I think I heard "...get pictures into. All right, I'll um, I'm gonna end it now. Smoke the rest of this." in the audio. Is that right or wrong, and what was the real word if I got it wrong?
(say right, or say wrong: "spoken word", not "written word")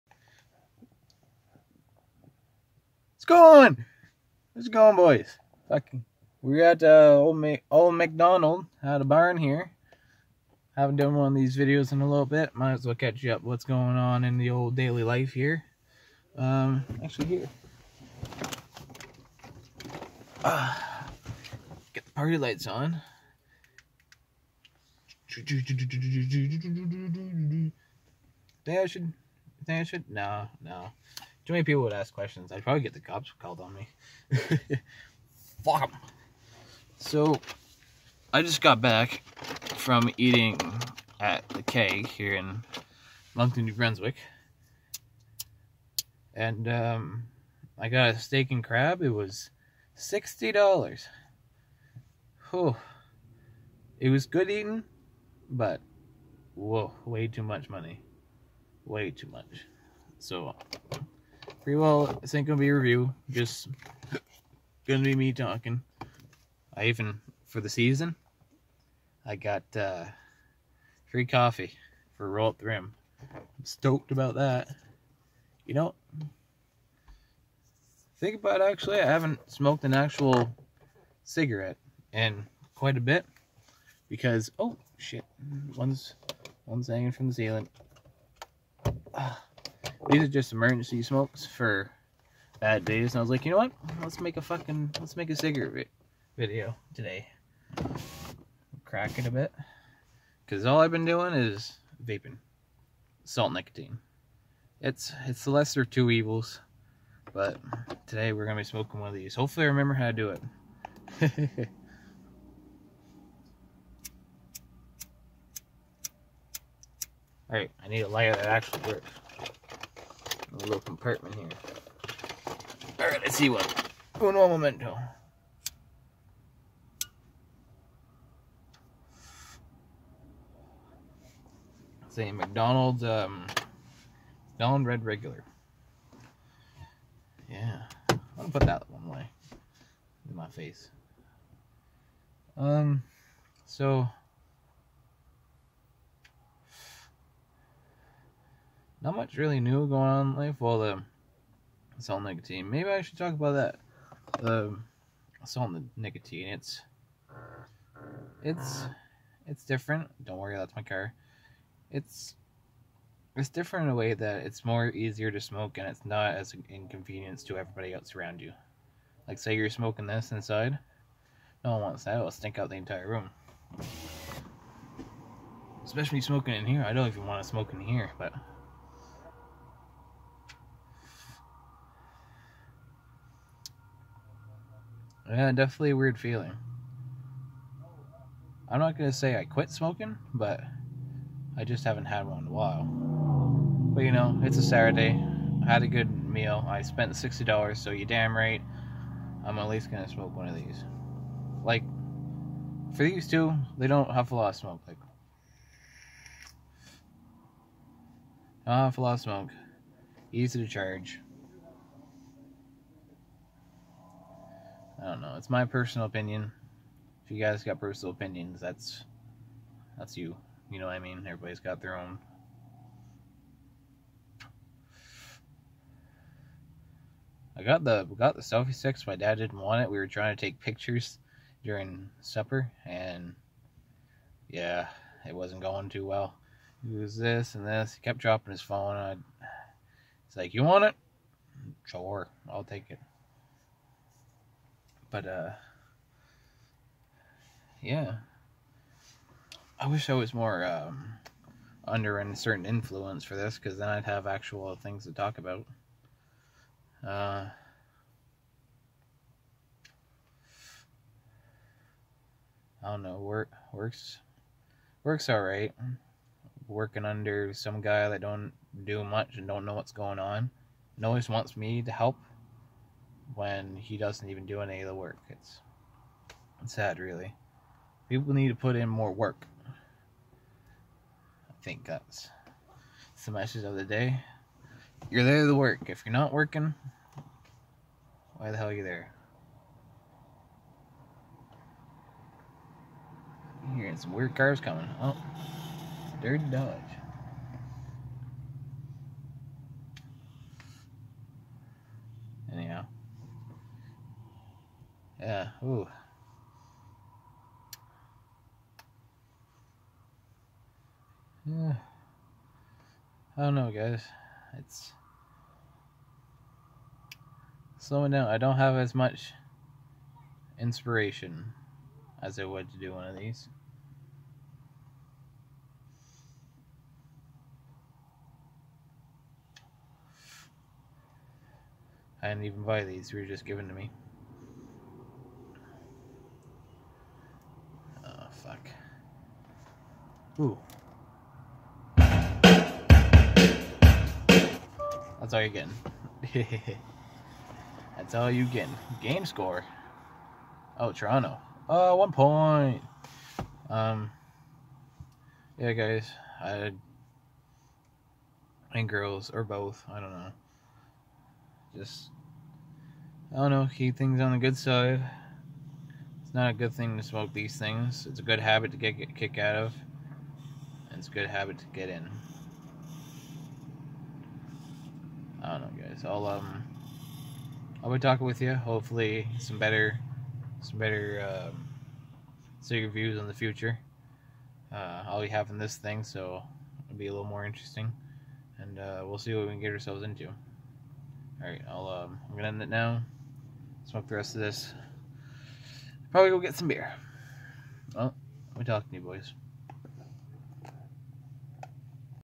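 wrong: "ourselves", not "pictures".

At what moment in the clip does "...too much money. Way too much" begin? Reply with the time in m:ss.
0:57.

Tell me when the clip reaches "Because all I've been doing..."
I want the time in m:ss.
1:40.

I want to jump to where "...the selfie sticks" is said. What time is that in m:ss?
3:48.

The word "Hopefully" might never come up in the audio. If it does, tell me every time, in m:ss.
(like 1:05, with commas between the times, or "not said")
1:49, 6:18.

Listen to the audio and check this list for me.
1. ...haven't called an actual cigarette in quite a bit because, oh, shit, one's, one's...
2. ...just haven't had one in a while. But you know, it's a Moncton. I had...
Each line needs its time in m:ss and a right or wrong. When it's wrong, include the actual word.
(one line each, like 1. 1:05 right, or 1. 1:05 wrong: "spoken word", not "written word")
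1. 1:19 wrong: "smoked", not "called"
2. 3:11 wrong: "Saturday", not "Moncton".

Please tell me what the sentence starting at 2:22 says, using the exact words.
Um, so Not much really new going on in life.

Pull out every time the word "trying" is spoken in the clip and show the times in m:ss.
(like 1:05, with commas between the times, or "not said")
3:50.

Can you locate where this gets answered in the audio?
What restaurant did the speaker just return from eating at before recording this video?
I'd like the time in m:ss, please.
0:41.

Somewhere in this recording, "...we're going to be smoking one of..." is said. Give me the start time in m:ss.
1:48.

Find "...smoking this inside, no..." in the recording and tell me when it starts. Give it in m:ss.
2:49.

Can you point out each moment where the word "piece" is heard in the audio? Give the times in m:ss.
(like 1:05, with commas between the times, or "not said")
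not said.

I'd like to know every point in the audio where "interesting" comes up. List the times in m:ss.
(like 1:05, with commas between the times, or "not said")
6:27.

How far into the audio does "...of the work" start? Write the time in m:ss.
4:34.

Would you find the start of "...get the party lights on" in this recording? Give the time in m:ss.
0:21.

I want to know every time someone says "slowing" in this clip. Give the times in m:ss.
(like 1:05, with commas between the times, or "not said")
5:17.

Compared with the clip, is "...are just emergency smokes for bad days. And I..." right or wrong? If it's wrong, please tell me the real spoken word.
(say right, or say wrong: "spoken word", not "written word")
right.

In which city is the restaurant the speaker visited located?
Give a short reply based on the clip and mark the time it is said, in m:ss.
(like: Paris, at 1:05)
Moncton, at 0:43.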